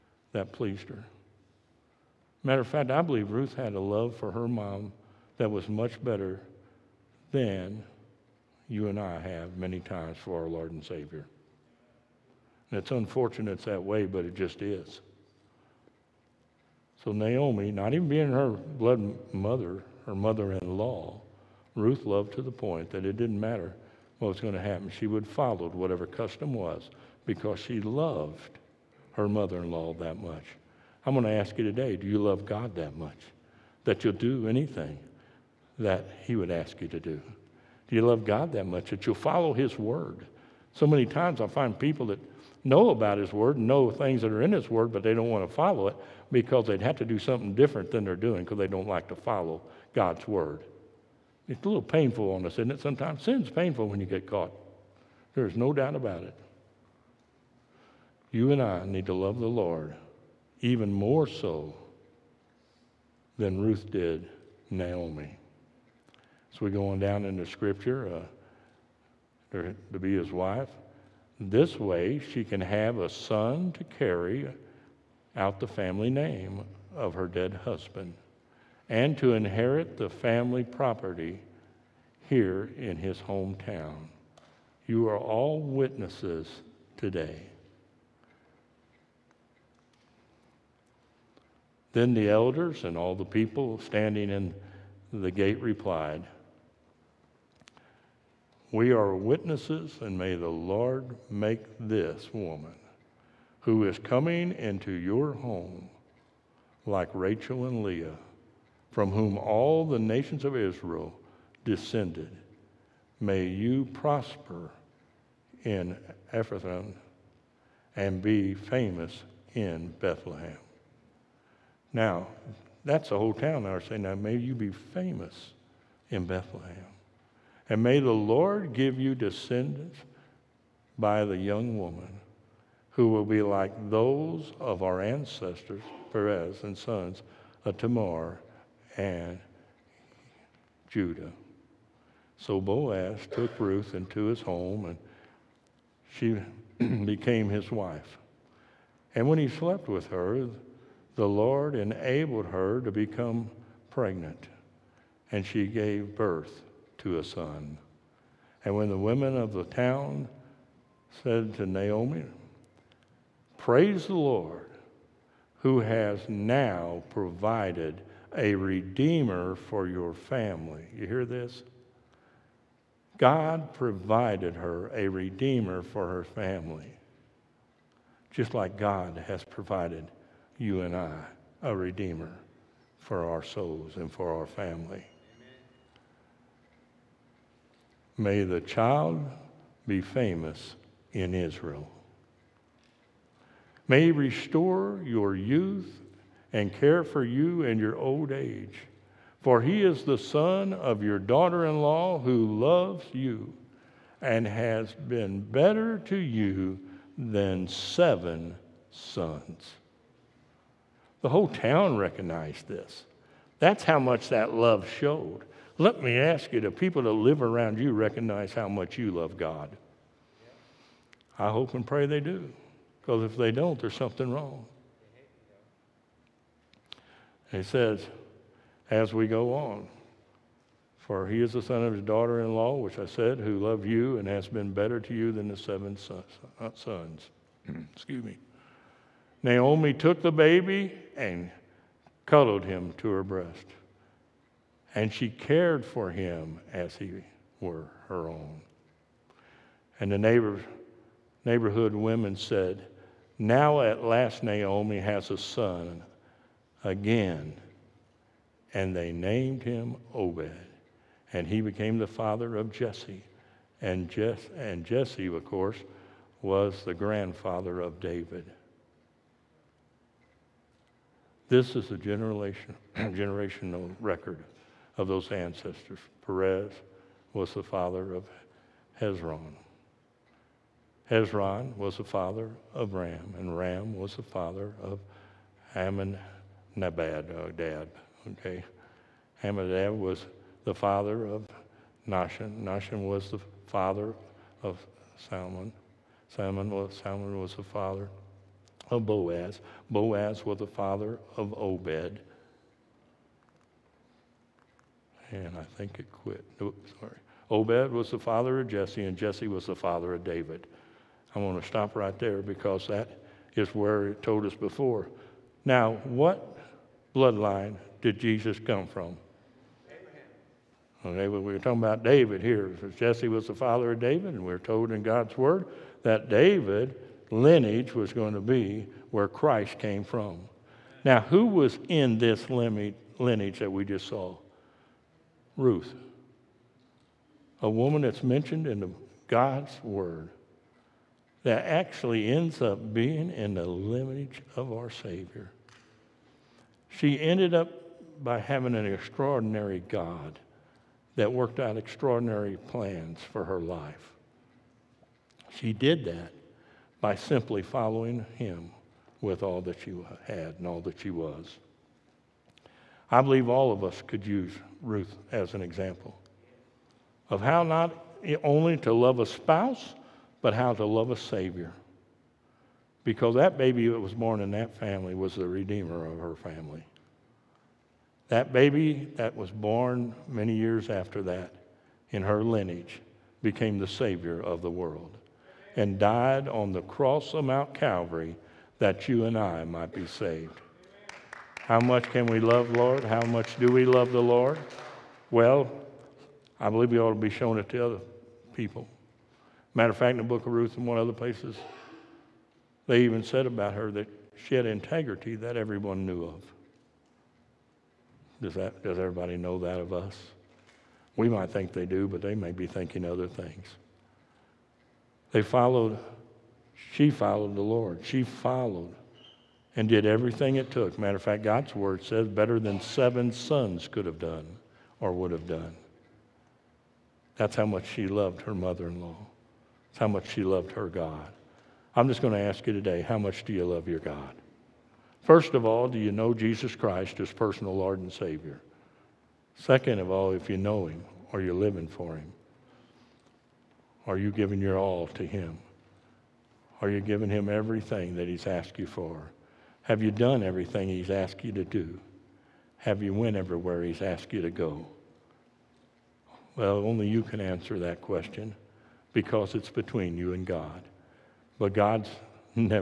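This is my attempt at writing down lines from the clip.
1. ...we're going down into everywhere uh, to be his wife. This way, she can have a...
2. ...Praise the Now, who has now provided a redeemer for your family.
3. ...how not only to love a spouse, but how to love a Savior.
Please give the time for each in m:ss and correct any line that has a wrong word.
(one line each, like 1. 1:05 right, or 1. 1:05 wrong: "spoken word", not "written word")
1. 1:06 wrong: "scripture", not "everywhere"
2. 2:43 wrong: "Lord", not "Now"
3. 6:07 right.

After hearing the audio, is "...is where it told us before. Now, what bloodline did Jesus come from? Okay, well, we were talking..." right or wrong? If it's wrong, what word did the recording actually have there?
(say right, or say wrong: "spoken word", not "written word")
right.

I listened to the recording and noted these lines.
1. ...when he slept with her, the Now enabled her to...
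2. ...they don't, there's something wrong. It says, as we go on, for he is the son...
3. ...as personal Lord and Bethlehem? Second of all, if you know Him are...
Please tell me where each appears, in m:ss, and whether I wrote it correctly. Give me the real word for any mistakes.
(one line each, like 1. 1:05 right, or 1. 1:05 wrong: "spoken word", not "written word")
1. 2:29 wrong: "Lord", not "Now"
2. 3:43 right
3. 7:17 wrong: "Savior", not "Bethlehem".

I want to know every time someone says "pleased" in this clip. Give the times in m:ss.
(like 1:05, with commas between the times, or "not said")
0:00.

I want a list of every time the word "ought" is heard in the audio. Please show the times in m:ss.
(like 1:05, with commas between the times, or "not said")
6:36.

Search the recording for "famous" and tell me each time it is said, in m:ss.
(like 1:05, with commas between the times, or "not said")
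1:58, 2:04, 3:10.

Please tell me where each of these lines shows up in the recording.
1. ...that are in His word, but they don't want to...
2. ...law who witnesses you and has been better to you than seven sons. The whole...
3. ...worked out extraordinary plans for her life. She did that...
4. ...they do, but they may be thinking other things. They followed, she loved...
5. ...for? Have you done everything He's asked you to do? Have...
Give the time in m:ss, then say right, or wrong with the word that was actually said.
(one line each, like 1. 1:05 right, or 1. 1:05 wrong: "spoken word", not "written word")
1. 0:44 right
2. 3:21 wrong: "loves", not "witnesses"
3. 5:51 right
4. 6:51 wrong: "followed", not "loved"
5. 7:28 right.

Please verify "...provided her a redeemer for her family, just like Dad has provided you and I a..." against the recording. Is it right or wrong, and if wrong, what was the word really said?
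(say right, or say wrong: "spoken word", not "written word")
wrong: "God", not "Dad".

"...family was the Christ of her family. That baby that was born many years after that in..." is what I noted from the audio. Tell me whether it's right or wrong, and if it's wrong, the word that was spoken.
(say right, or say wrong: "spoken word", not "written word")
wrong: "Redeemer", not "Christ".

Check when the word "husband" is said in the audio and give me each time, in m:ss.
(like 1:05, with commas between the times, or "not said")
1:17.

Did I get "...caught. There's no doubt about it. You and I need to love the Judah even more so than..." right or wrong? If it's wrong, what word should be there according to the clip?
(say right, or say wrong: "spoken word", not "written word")
wrong: "Lord", not "Judah".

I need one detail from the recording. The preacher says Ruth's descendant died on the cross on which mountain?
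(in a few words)
Mount Calvary.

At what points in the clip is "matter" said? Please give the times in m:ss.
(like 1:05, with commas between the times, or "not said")
0:02, 0:23, 6:39, 7:00.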